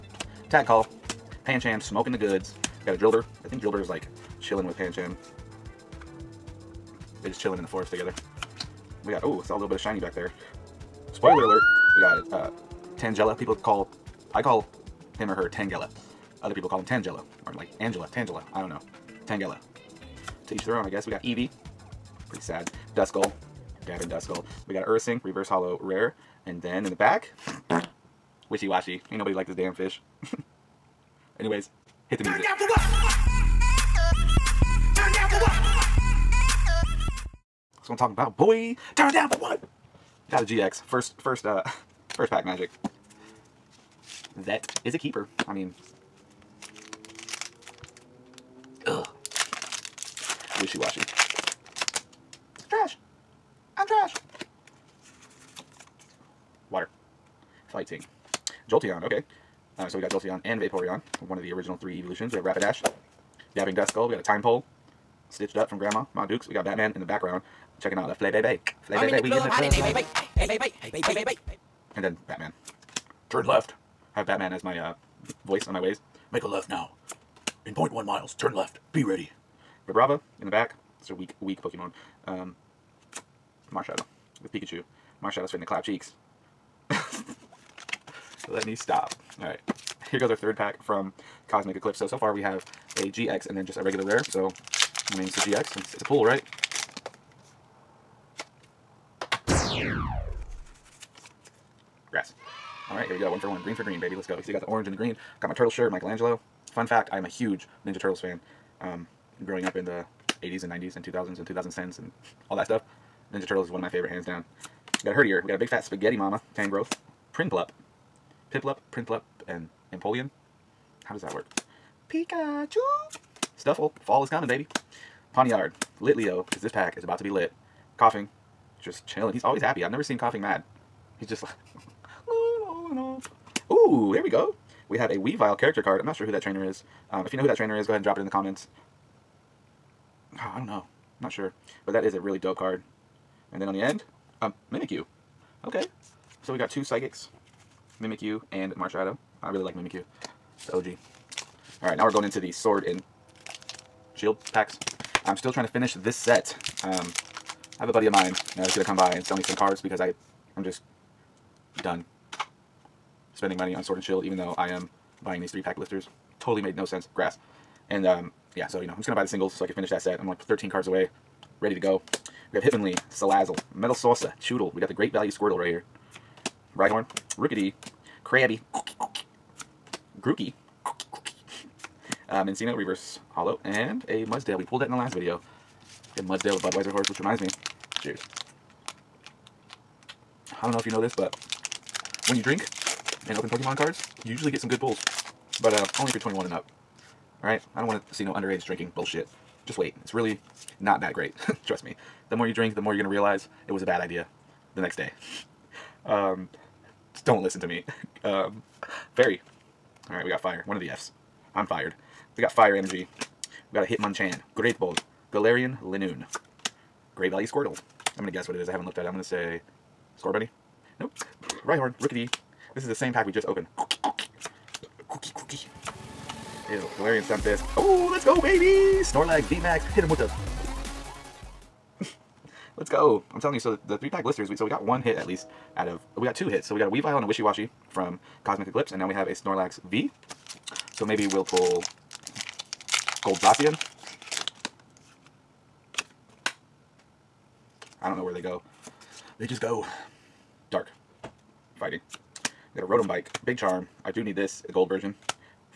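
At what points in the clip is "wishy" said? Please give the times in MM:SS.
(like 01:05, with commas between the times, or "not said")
00:28, 00:50, 03:57.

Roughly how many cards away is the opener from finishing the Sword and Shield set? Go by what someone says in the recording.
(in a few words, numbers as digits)
13.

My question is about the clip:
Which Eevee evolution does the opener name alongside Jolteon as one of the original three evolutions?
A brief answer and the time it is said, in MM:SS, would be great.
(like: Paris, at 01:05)
Vaporeon, at 01:00.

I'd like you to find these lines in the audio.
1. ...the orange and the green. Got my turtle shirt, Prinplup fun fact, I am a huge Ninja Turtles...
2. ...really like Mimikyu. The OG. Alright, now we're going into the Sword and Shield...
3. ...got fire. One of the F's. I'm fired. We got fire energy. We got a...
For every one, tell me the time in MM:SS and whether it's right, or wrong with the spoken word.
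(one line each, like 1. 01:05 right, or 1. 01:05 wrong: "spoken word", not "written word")
1. 01:44 wrong: "Michelangelo", not "Prinplup"
2. 02:29 right
3. 03:30 right.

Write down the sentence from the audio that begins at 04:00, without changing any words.
So maybe we'll pull Gold Goldbrassian.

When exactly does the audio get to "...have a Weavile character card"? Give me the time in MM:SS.
02:14.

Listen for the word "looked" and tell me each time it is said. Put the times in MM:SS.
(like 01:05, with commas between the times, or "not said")
03:38.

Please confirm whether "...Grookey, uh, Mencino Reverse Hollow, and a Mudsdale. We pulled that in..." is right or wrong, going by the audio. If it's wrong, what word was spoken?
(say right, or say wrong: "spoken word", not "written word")
right.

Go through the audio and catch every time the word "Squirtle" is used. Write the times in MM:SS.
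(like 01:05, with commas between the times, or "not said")
02:55, 03:37.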